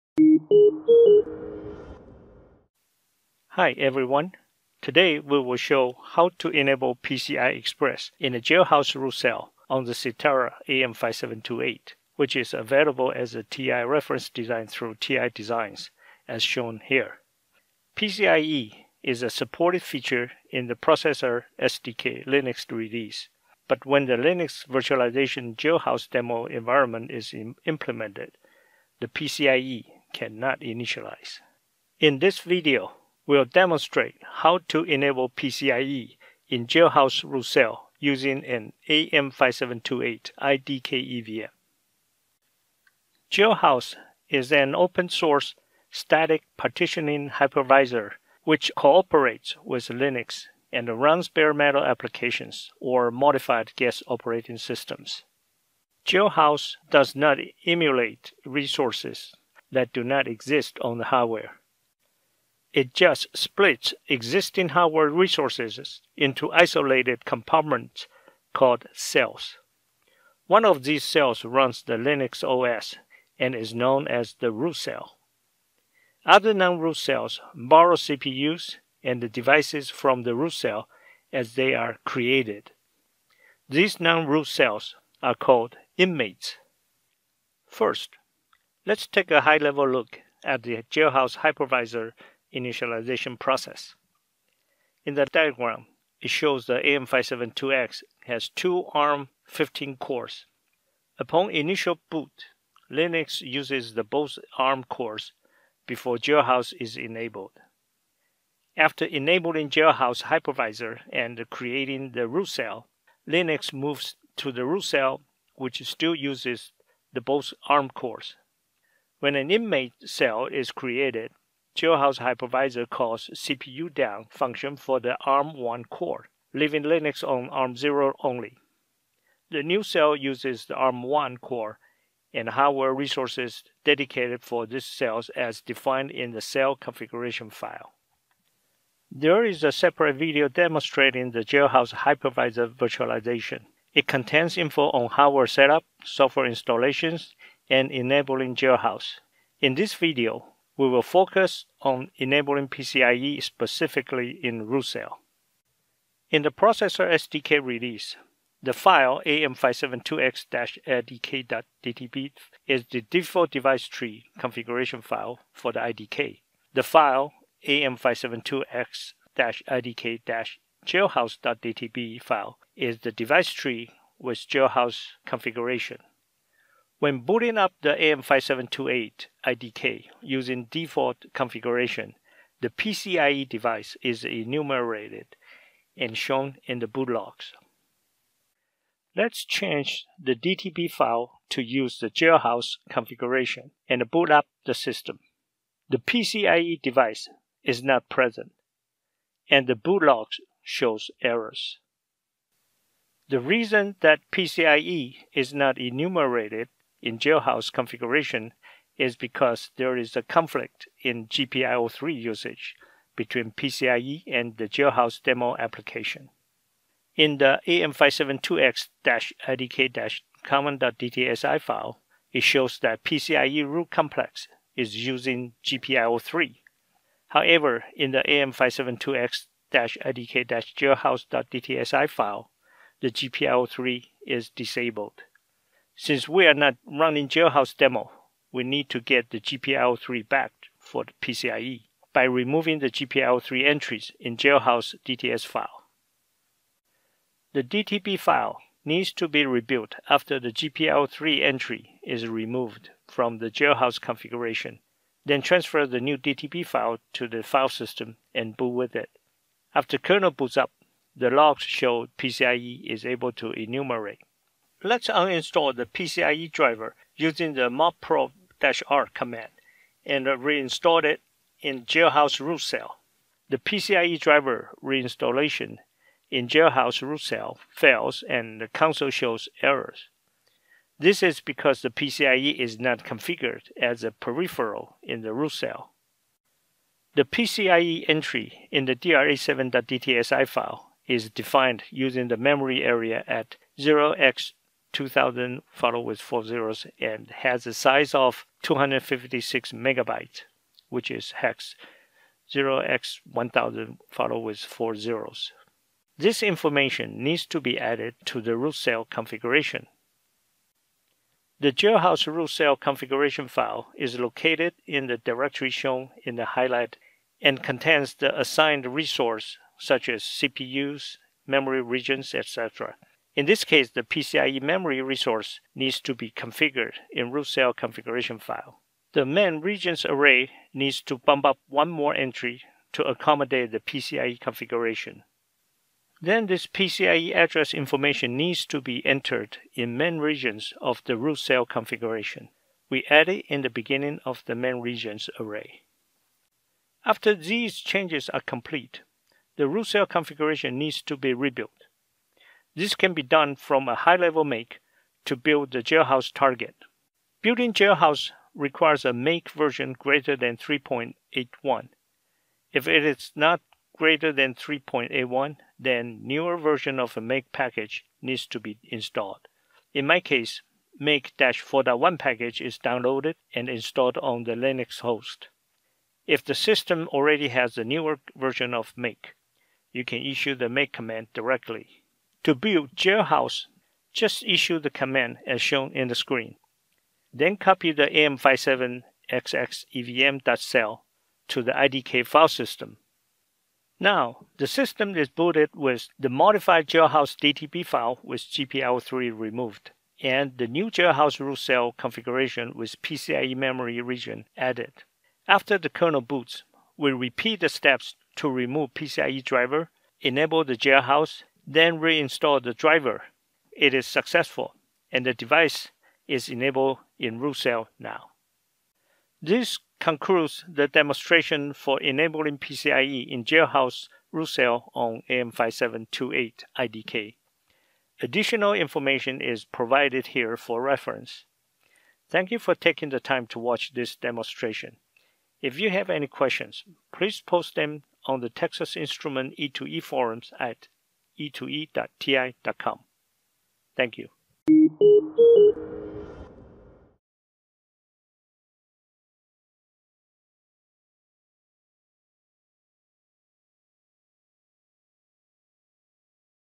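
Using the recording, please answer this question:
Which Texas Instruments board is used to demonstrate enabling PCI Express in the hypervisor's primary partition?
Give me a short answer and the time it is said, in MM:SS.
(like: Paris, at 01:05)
AM5728 IDK EVM, at 00:38.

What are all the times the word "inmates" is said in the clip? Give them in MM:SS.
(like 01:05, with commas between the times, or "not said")
01:25, 01:59.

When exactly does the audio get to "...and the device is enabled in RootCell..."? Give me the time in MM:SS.
06:55.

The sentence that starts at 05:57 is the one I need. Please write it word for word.
Building jailhouse requires a make version greater than 3.81.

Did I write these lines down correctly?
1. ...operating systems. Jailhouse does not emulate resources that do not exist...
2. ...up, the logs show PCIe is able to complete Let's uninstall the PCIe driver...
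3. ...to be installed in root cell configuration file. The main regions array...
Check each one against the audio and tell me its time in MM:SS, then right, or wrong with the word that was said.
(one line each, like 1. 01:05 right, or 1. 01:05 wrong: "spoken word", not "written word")
1. 00:54 right
2. 04:20 wrong: "enumerate", not "complete"
3. 05:26 wrong: "configured", not "installed".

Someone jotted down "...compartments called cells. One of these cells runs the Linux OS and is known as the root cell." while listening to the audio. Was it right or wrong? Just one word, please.
right.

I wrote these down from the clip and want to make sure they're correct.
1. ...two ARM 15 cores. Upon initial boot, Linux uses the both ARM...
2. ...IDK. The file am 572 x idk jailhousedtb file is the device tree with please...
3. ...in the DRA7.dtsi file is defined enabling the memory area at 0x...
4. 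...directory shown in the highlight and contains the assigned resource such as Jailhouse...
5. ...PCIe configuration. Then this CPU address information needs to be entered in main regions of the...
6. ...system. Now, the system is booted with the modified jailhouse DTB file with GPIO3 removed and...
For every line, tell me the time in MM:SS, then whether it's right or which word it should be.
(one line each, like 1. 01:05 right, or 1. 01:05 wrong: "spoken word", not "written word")
1. 01:38 right
2. 02:45 wrong: "jailhouse", not "please"
3. 04:48 wrong: "using", not "enabling"
4. 05:15 wrong: "CPUs", not "Jailhouse"
5. 05:33 wrong: "PCIe", not "CPU"
6. 06:32 right.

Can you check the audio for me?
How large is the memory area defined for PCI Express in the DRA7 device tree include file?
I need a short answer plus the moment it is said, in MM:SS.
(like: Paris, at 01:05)
256 megabytes, at 04:58.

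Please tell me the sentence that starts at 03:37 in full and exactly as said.
In the am572x-idk-common.dtsi file, it shows that PCIe root complex is using GPIO3.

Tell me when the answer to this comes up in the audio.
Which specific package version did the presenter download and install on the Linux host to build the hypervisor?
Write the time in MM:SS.
06:10.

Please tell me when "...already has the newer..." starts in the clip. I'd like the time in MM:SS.
06:17.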